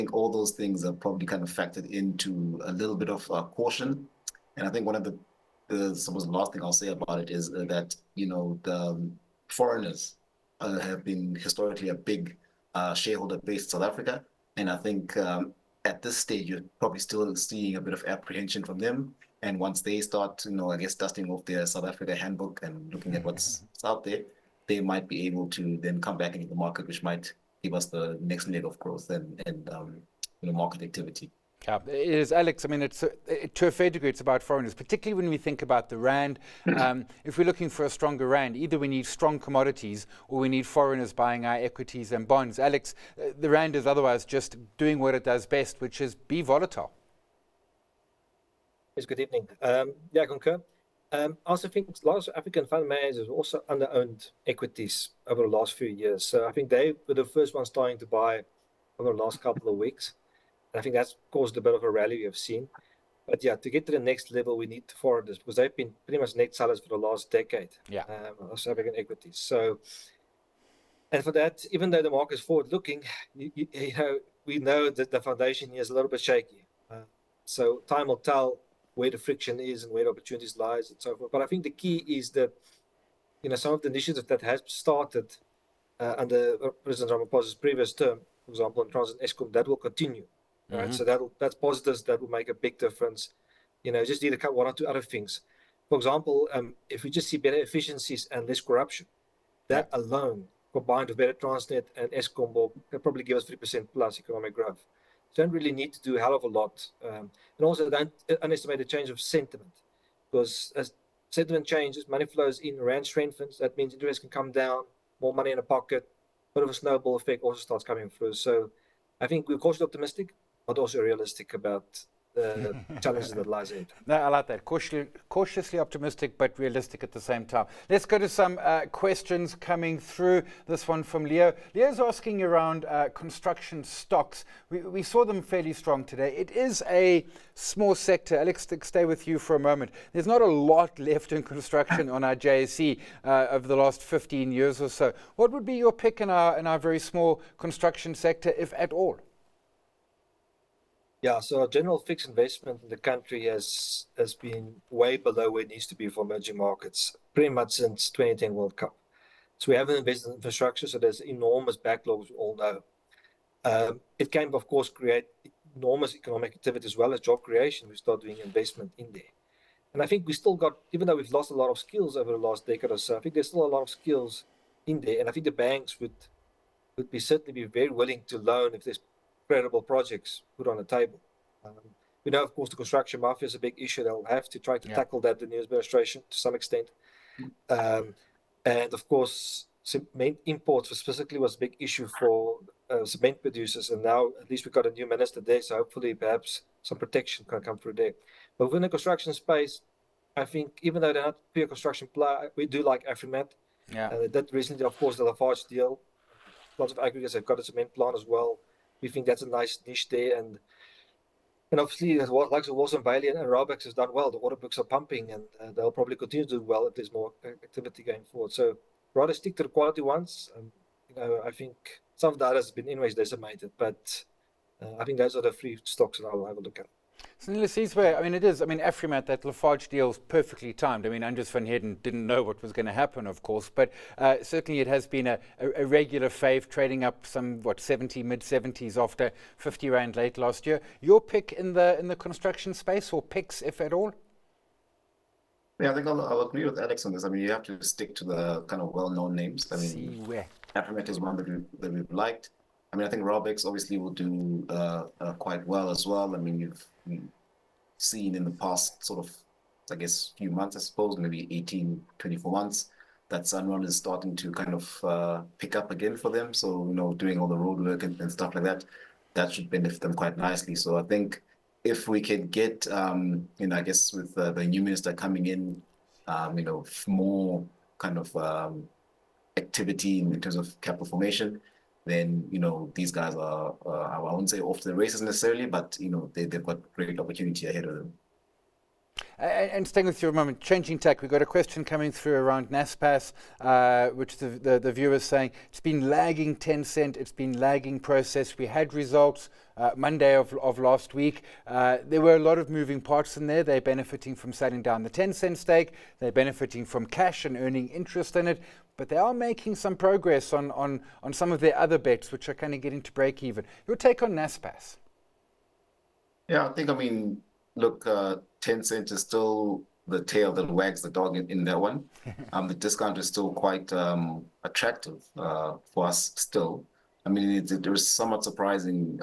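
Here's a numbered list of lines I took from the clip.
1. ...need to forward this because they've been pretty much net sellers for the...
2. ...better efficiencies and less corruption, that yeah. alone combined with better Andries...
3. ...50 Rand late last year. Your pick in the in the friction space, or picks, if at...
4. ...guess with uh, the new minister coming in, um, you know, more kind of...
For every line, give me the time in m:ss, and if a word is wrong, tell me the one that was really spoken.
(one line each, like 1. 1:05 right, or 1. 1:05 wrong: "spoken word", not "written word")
1. 1:04 right
2. 1:37 wrong: "Transnet", not "Andries"
3. 3:59 wrong: "construction", not "friction"
4. 4:33 right.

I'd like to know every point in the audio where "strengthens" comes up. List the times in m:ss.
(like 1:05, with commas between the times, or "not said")
1:53.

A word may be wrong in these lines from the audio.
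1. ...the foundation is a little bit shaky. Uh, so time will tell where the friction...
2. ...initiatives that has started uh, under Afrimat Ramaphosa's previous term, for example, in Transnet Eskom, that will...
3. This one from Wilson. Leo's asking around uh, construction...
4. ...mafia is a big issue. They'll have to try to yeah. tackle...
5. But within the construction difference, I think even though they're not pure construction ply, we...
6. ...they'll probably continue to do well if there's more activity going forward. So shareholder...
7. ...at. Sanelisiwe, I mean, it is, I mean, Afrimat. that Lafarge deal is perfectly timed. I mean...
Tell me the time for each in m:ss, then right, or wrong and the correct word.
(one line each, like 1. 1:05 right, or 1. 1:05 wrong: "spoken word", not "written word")
1. 1:15 right
2. 1:23 wrong: "President", not "Afrimat"
3. 2:10 wrong: "Leo", not "Wilson"
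4. 3:03 right
5. 3:18 wrong: "space", not "difference"
6. 3:35 wrong: "rather", not "shareholder"
7. 3:46 right.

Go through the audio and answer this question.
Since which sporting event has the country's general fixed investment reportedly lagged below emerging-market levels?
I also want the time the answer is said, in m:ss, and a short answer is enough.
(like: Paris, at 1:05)
2010 World Cup, at 2:38.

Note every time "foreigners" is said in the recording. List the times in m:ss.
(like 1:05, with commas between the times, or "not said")
0:09, 0:34, 0:40.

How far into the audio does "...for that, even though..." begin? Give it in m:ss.
1:11.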